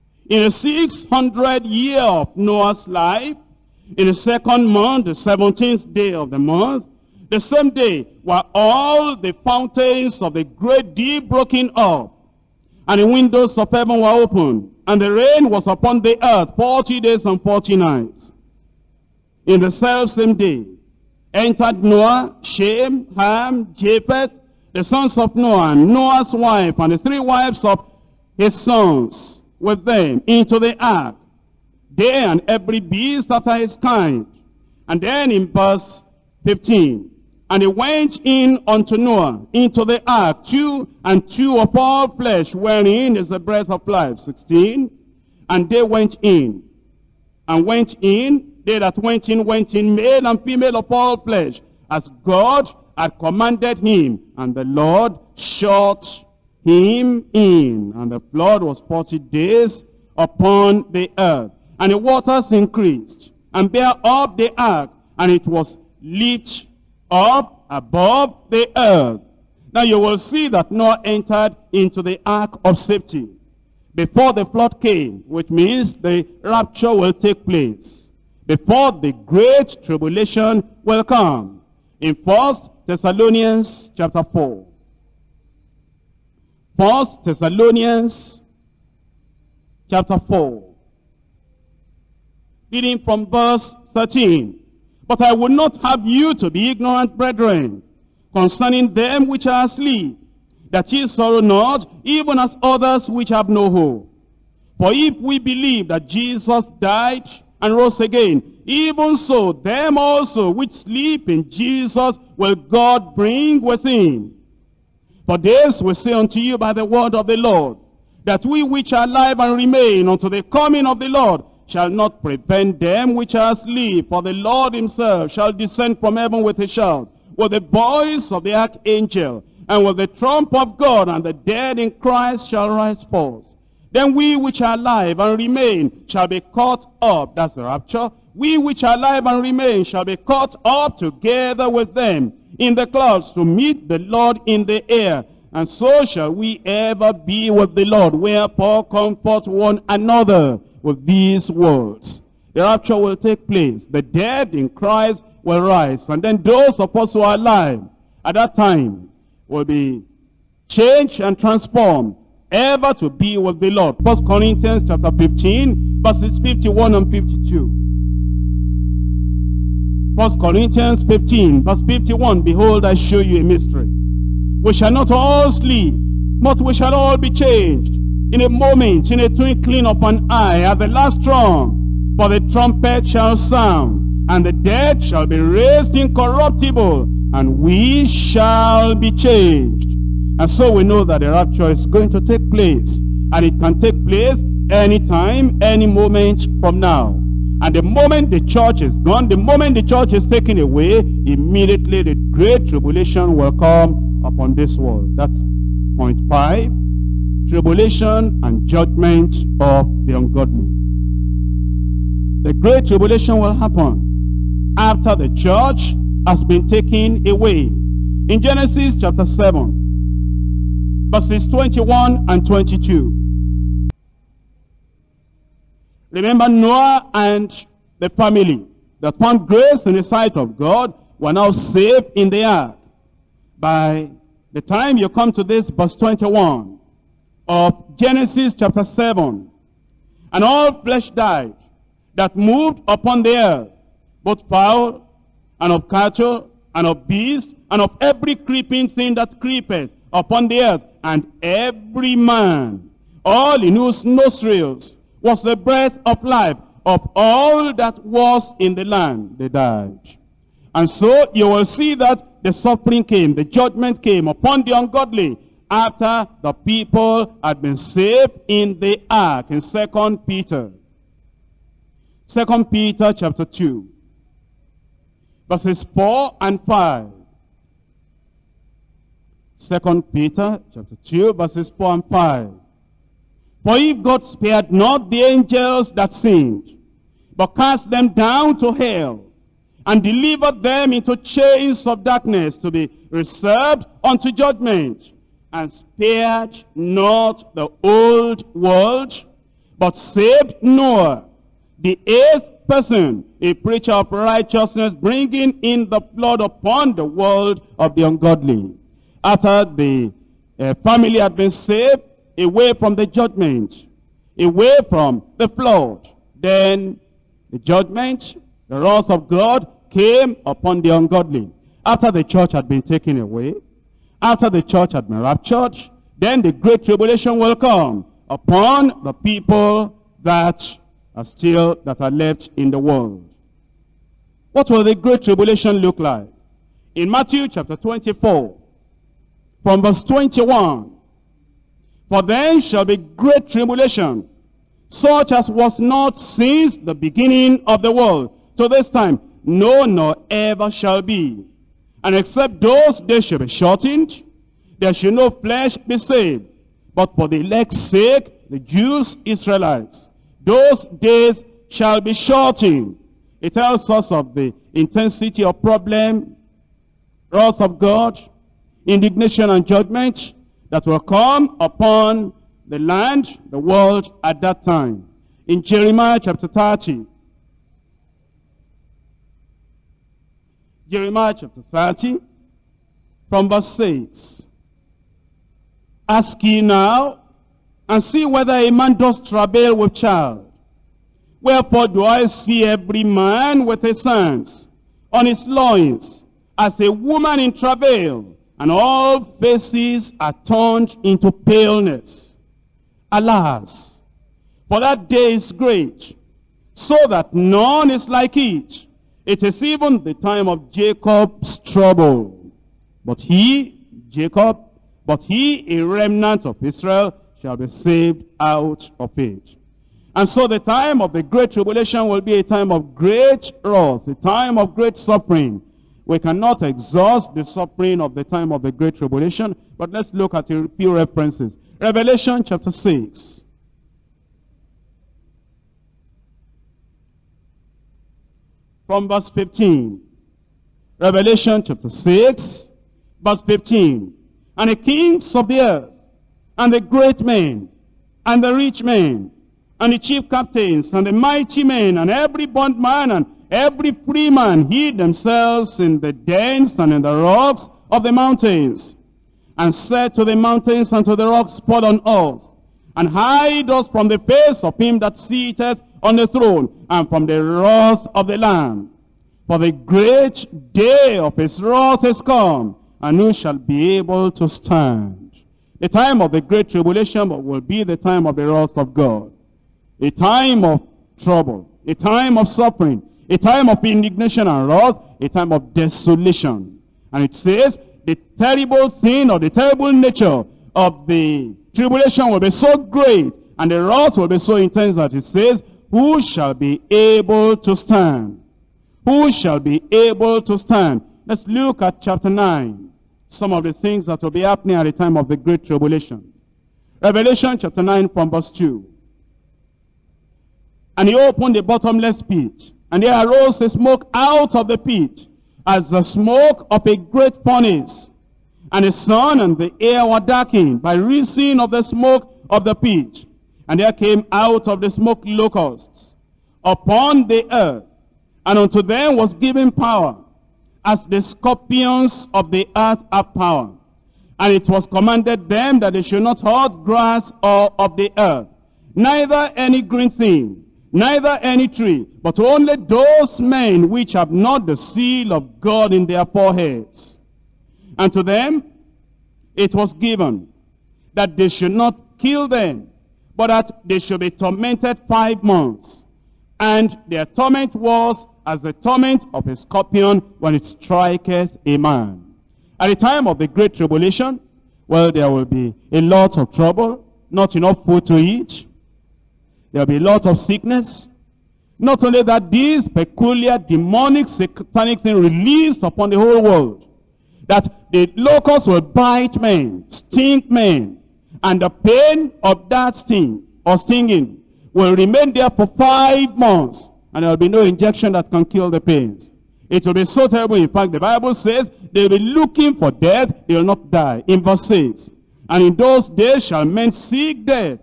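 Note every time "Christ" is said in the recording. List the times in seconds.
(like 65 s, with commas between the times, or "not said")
131 s, 154 s.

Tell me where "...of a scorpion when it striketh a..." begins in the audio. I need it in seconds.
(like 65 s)
559 s.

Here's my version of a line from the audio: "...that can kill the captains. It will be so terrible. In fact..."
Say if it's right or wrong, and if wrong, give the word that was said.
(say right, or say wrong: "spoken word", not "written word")
wrong: "pains", not "captains".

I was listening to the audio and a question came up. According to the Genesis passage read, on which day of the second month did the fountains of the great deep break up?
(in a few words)
17th.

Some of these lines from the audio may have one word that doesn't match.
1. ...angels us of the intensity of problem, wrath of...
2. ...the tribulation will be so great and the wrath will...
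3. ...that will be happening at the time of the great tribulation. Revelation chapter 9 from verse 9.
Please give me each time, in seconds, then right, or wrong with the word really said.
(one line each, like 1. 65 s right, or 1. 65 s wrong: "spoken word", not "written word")
1. 363 s wrong: "tells", not "angels"
2. 491 s right
3. 504 s wrong: "2", not "9".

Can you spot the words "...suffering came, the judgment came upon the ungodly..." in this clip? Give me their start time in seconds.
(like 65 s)
262 s.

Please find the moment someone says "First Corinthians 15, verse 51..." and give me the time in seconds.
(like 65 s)
170 s.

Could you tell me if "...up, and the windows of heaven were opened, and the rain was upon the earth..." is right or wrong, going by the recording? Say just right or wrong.
right.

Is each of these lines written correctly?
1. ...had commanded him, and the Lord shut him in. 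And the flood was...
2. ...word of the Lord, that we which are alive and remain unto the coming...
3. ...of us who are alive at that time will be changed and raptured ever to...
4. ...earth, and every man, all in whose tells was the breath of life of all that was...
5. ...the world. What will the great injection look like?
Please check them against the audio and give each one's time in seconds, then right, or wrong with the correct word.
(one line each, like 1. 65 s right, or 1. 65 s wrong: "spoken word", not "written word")
1. 52 s right
2. 116 s right
3. 156 s wrong: "transformed", not "raptured"
4. 250 s wrong: "nostrils", not "tells"
5. 332 s wrong: "tribulation", not "injection".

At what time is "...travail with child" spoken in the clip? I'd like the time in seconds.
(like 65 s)
389 s.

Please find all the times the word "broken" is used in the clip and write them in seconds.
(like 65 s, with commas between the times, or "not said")
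11 s.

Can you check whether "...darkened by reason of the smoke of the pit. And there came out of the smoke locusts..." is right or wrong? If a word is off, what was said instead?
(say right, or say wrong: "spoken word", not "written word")
right.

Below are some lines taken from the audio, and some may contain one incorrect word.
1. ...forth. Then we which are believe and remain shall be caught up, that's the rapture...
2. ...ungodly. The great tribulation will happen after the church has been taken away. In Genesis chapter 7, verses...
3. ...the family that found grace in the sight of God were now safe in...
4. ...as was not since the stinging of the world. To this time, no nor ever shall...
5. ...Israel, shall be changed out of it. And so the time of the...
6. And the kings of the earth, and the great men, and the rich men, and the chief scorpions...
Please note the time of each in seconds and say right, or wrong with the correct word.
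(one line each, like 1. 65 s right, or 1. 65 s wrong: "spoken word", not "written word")
1. 133 s wrong: "alive", not "believe"
2. 210 s right
3. 227 s right
4. 345 s wrong: "beginning", not "stinging"
5. 416 s wrong: "saved", not "changed"
6. 444 s wrong: "captains", not "scorpions".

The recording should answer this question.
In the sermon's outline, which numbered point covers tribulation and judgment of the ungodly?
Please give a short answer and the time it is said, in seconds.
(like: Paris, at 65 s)
5, at 205 s.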